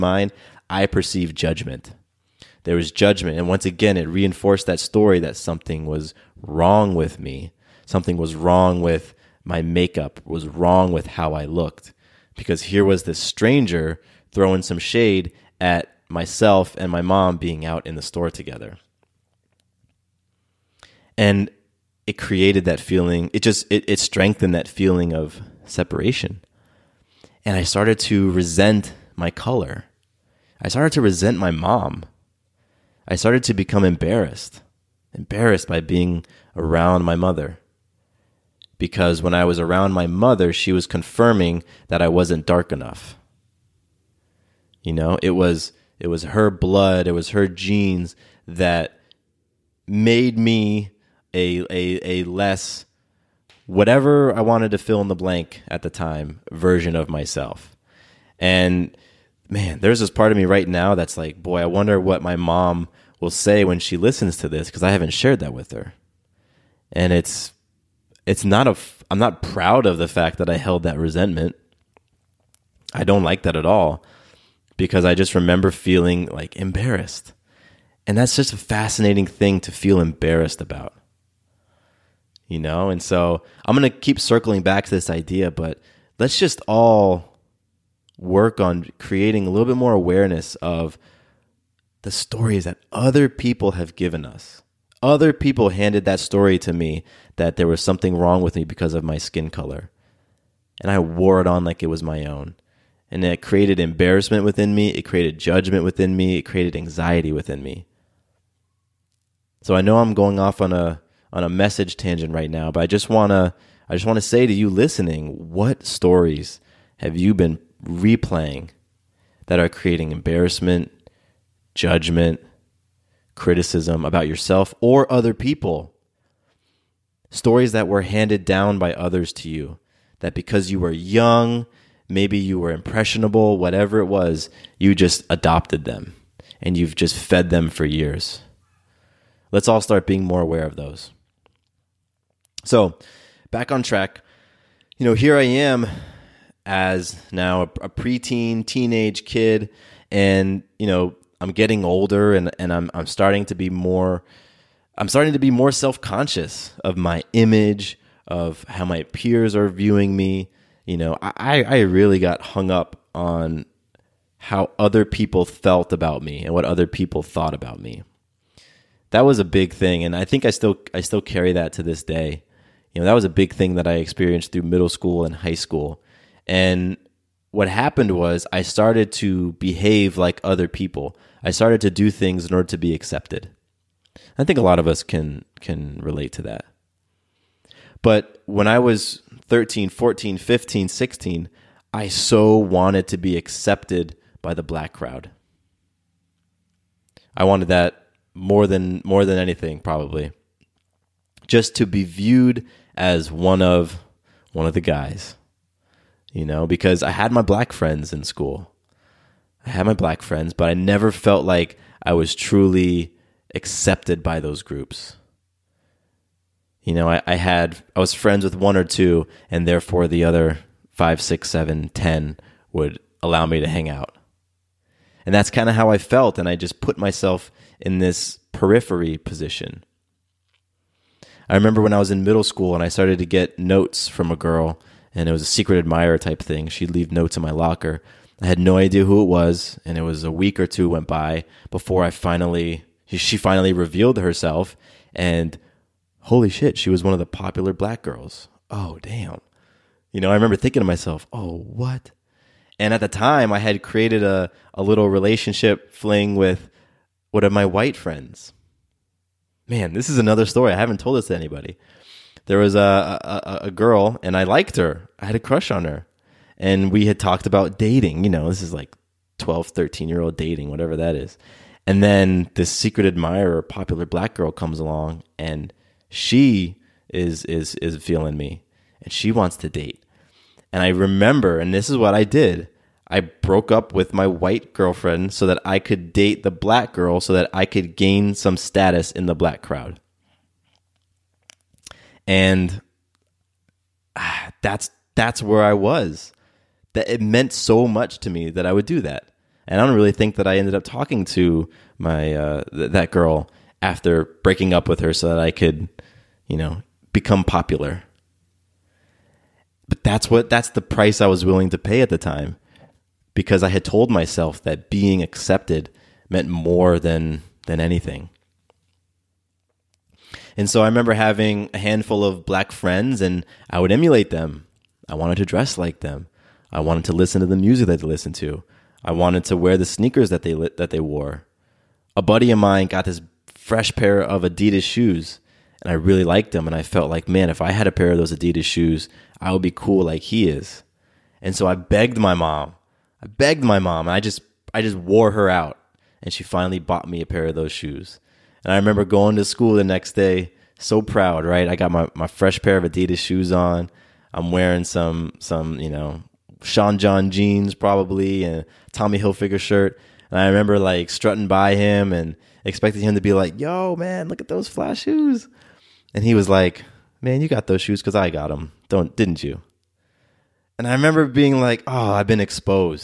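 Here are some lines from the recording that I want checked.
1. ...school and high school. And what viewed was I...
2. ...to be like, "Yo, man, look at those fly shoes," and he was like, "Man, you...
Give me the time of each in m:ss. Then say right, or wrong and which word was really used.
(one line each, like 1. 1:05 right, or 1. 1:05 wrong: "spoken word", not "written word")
1. 2:54 wrong: "happened", not "viewed"
2. 6:03 right.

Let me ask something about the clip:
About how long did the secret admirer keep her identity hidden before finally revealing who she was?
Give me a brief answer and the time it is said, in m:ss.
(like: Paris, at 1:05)
a week or two, at 4:00.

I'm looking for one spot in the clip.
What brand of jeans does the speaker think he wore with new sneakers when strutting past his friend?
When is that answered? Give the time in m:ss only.
5:56.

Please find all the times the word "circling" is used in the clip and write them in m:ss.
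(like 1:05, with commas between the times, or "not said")
1:24.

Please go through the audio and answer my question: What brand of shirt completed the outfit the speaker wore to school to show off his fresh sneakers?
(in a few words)
Tommy Hilfiger.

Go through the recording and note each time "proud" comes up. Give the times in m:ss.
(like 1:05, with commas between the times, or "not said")
1:09, 5:51.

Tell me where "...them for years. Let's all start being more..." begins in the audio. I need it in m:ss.
2:17.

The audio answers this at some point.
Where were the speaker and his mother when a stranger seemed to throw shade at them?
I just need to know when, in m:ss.
0:17.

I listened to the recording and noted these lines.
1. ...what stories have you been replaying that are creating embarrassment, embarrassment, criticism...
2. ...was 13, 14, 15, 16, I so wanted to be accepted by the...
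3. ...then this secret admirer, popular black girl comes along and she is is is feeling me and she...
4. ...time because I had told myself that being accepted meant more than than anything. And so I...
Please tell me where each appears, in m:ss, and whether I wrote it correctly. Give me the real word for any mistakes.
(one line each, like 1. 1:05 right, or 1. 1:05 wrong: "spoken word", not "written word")
1. 1:55 wrong: "judgment", not "embarrassment"
2. 3:08 right
3. 4:32 right
4. 5:12 right.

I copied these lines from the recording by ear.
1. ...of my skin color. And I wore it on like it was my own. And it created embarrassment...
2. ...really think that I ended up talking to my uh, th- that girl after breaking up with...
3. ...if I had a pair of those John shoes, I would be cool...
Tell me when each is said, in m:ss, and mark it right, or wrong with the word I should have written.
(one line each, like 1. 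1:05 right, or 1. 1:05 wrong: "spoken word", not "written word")
1. 1:38 right
2. 4:59 right
3. 5:37 wrong: "Adidas", not "John".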